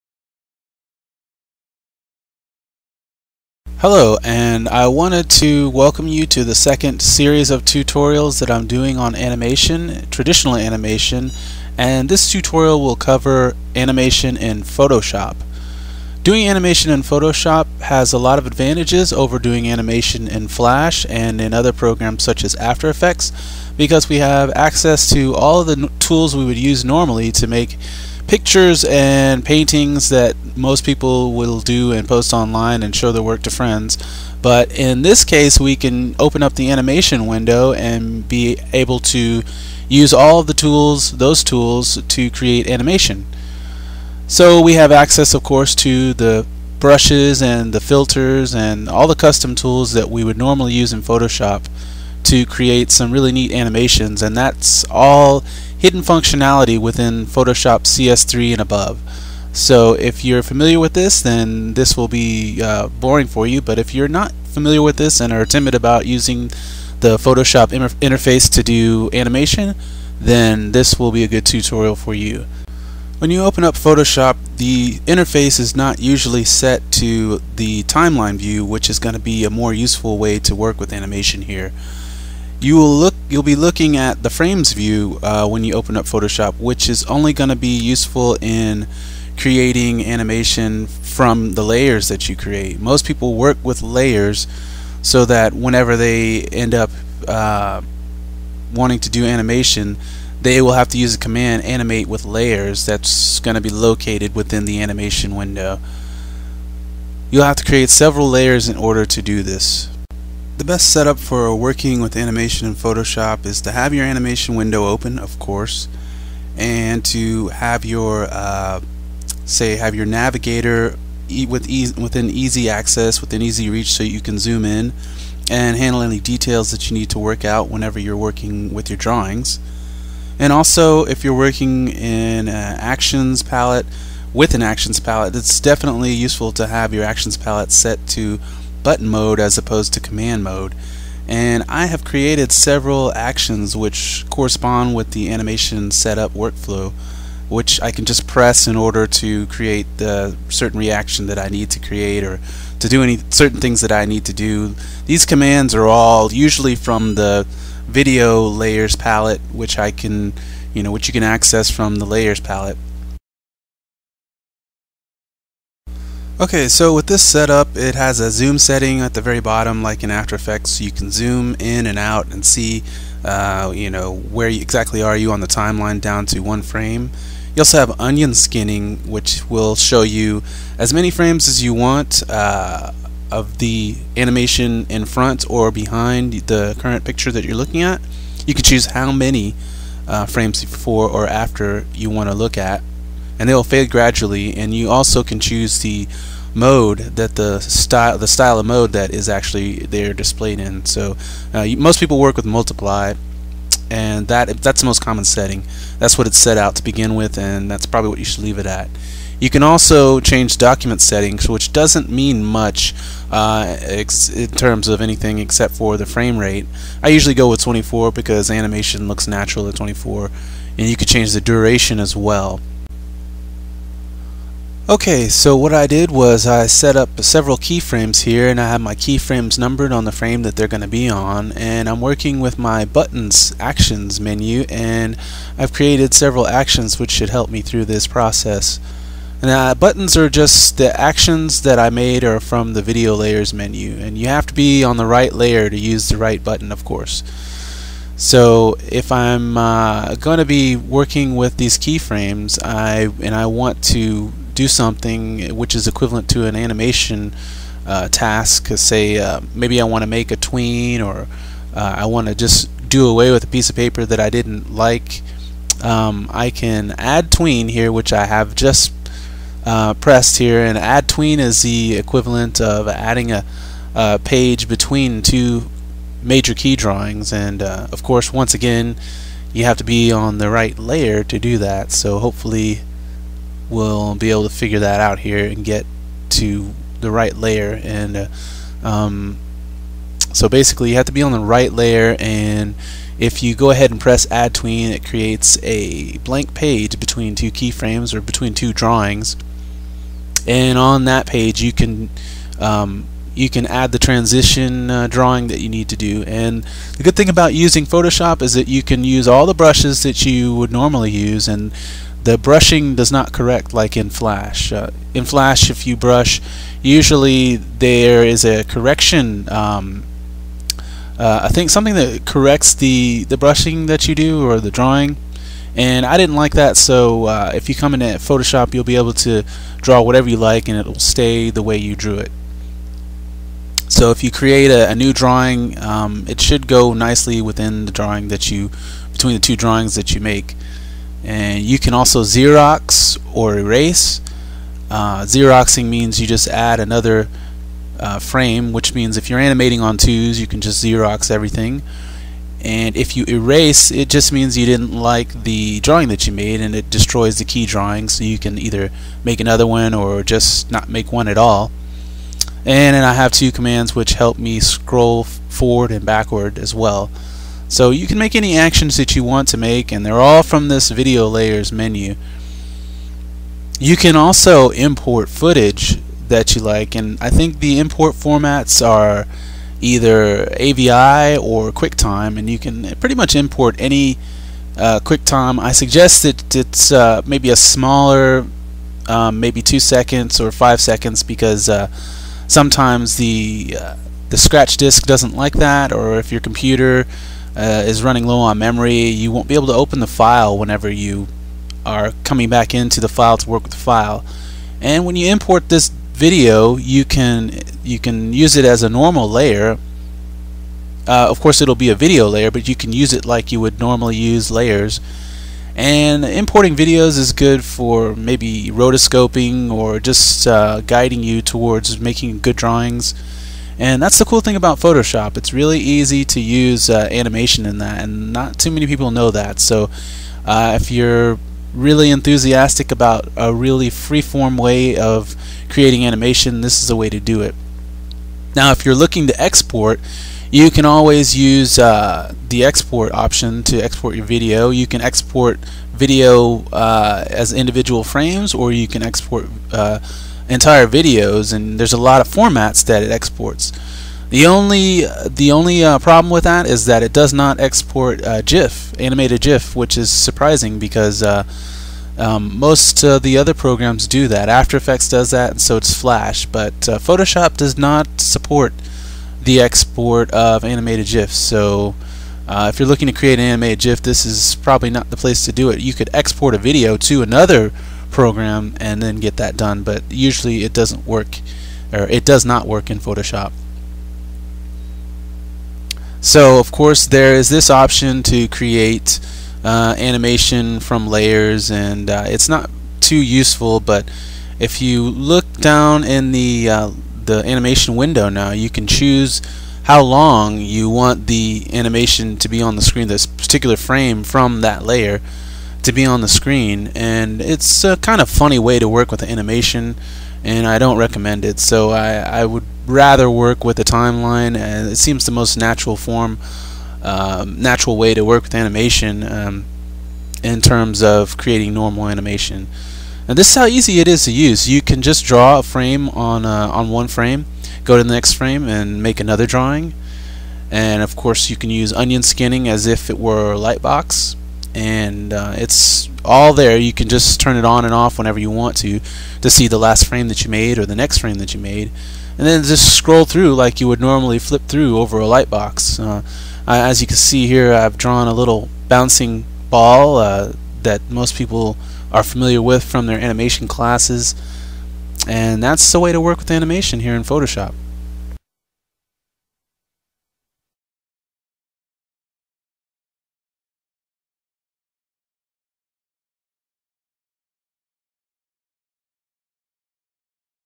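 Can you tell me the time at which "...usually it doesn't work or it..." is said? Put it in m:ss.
8:00.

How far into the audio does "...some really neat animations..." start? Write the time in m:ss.
0:52.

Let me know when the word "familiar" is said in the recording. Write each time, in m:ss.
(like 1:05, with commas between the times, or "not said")
1:00, 1:04, 9:12.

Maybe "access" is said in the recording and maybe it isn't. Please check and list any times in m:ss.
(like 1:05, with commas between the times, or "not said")
0:24, 0:44, 2:02, 2:41.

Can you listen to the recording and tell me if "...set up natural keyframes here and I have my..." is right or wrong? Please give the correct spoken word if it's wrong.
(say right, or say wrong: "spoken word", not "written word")
wrong: "several", not "natural".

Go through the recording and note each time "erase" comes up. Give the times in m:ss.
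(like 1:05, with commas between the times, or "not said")
5:43, 5:53.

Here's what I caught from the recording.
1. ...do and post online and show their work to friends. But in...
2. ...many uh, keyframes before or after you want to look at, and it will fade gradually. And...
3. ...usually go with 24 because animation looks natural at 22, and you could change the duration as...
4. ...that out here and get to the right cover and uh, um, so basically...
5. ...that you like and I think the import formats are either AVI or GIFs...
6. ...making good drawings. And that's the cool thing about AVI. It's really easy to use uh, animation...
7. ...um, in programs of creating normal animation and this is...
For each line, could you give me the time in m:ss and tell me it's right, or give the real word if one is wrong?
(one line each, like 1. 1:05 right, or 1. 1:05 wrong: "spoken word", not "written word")
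1. 0:31 right
2. 3:09 wrong: "frames", not "keyframes"
3. 3:37 wrong: "24", not "22"
4. 4:44 wrong: "layer", not "cover"
5. 6:16 wrong: "QuickTime", not "GIFs"
6. 7:01 wrong: "Photoshop", not "AVI"
7. 8:39 wrong: "terms", not "programs".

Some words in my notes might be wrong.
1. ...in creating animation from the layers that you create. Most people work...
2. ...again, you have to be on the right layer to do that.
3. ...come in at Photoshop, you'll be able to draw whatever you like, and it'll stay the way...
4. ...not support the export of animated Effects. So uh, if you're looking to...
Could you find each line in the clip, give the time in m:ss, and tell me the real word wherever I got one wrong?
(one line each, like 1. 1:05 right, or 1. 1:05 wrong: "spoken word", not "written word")
1. 1:28 right
2. 4:38 right
3. 5:27 right
4. 7:47 wrong: "GIFs", not "Effects".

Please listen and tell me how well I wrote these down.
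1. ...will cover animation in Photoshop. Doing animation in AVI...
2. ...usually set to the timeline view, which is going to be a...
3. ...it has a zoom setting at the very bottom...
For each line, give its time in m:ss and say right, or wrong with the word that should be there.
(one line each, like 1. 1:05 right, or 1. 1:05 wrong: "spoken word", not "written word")
1. 0:12 wrong: "Photoshop", not "AVI"
2. 1:15 right
3. 2:47 right.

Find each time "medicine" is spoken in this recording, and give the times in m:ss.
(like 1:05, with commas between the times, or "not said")
not said.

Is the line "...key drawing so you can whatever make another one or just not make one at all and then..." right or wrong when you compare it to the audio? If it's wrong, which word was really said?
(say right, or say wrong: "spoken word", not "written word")
wrong: "either", not "whatever".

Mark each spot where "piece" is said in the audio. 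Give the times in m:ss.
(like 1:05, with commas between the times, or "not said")
4:23.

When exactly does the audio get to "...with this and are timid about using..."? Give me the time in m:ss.
1:04.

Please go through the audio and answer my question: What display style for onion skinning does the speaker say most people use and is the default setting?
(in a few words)
multiply.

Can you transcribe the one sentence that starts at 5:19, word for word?
Um, uh, I think something that corrects the the brushing that you do or the drawing.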